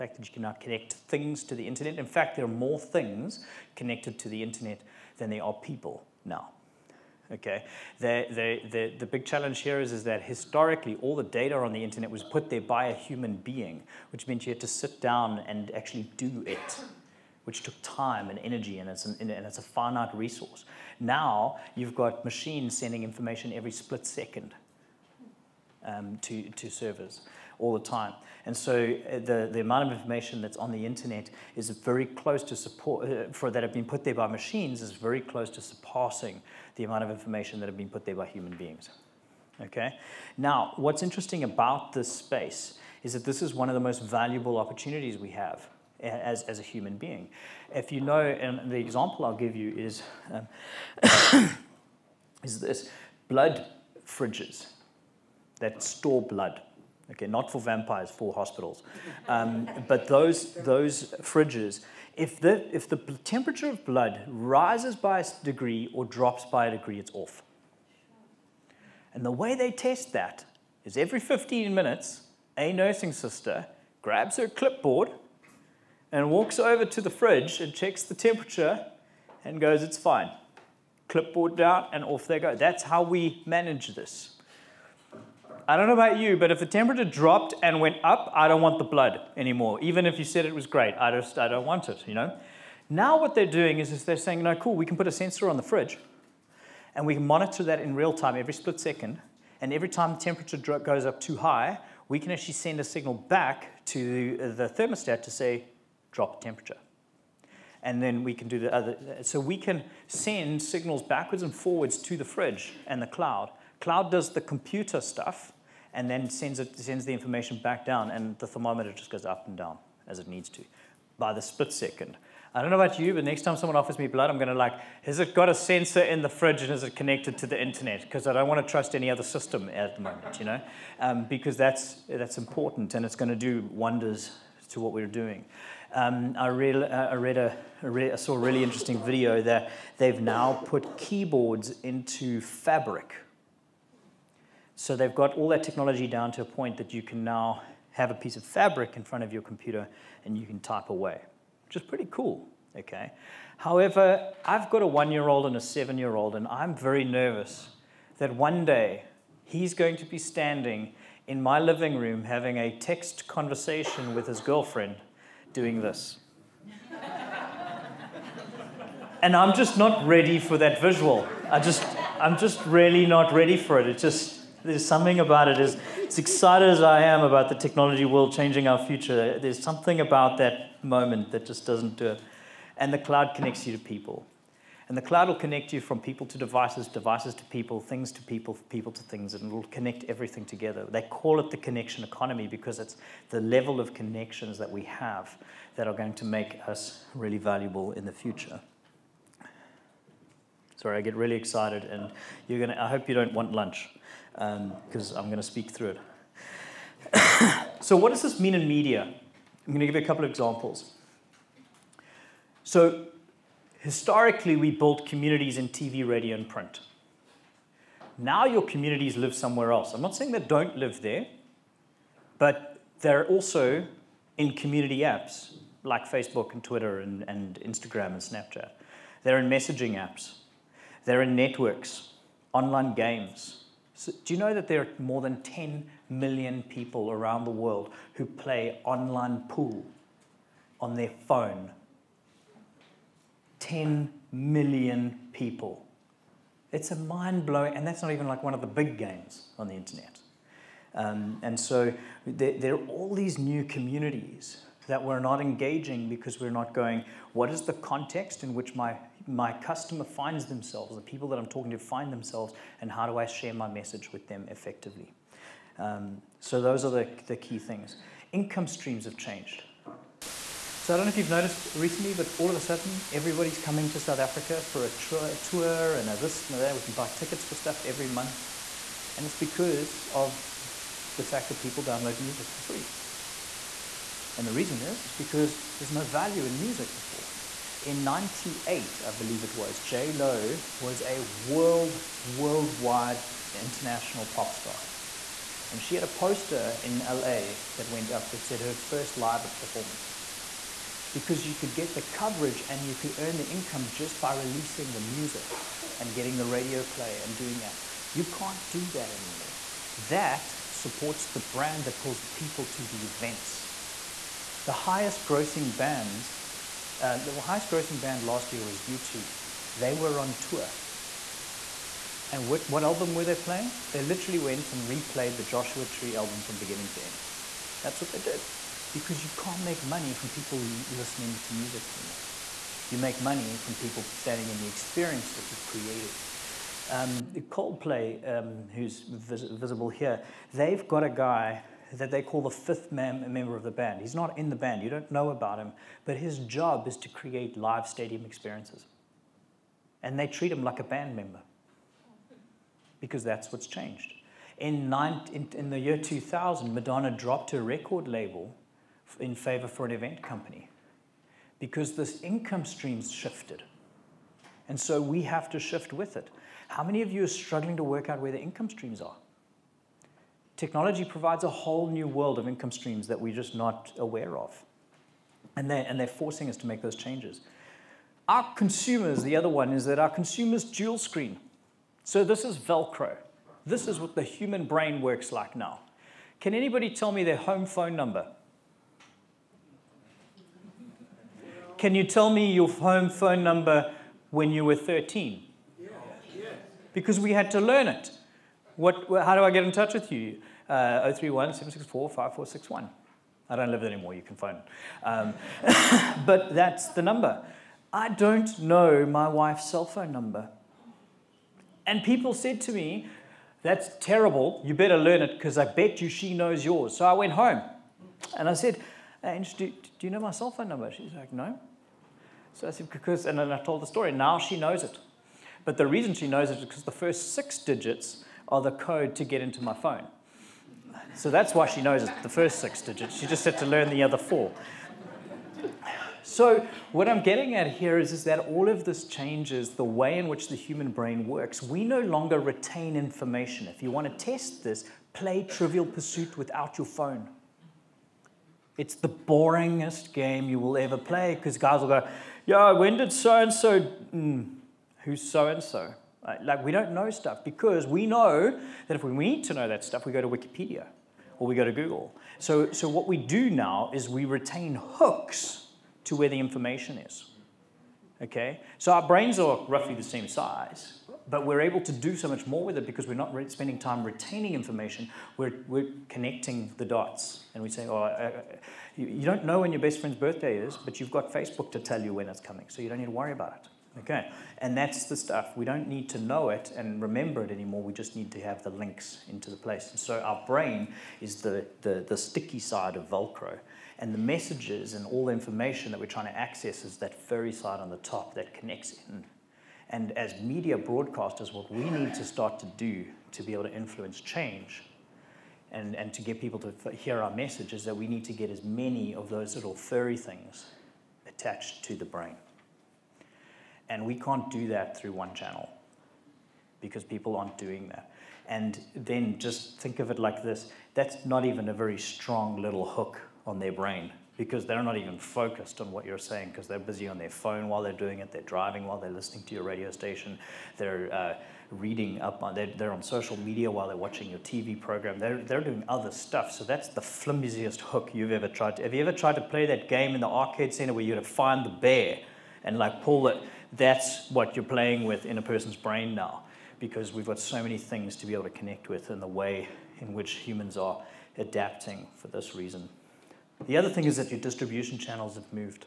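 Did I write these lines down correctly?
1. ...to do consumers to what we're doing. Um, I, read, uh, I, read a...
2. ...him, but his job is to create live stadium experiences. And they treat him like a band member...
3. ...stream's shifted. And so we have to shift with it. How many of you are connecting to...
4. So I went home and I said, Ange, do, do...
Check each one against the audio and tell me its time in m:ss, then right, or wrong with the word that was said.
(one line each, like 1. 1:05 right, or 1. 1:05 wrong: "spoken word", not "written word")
1. 2:13 wrong: "wonders", not "consumers"
2. 5:45 right
3. 6:02 wrong: "struggling", not "connecting"
4. 6:56 right.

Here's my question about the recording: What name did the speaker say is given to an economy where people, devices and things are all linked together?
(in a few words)
The connection economy.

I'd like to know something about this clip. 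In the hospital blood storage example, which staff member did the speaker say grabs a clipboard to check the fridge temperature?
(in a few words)
A nursing sister.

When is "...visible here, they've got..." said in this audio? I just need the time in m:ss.
5:39.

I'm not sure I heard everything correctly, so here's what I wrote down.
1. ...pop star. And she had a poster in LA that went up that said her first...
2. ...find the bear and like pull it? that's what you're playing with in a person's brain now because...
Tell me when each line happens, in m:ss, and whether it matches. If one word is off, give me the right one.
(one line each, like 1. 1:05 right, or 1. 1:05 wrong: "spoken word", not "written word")
1. 4:54 right
2. 9:01 right.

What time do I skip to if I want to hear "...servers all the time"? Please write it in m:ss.
0:26.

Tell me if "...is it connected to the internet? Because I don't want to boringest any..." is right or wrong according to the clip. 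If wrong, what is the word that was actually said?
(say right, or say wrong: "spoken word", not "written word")
wrong: "trust", not "boringest".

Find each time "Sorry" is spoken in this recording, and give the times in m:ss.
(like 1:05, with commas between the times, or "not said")
3:20.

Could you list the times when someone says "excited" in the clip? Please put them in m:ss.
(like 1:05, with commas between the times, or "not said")
2:56, 3:21.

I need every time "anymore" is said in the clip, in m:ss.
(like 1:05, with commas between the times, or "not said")
1:29, 5:09, 5:31, 6:43, 8:07.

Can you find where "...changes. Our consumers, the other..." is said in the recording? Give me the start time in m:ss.
6:16.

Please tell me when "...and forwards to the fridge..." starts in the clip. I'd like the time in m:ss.
1:51.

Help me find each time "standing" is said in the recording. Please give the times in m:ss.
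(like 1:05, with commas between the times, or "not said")
2:40, 5:34.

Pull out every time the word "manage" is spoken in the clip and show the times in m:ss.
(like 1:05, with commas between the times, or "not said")
1:23.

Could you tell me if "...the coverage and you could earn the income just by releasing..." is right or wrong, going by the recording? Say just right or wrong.
right.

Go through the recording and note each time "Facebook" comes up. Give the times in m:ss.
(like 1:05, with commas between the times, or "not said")
3:46, 8:01.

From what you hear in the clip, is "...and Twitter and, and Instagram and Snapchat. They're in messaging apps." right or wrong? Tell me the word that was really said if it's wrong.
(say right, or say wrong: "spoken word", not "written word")
right.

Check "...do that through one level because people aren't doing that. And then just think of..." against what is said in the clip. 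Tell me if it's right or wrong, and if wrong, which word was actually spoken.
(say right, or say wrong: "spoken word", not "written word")
wrong: "channel", not "level".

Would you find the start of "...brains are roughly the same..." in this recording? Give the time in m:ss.
7:49.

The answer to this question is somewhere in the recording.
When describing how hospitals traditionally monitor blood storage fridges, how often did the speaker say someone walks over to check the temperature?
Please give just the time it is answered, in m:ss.
1:10.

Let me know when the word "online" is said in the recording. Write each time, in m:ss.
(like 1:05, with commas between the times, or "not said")
3:52, 3:58.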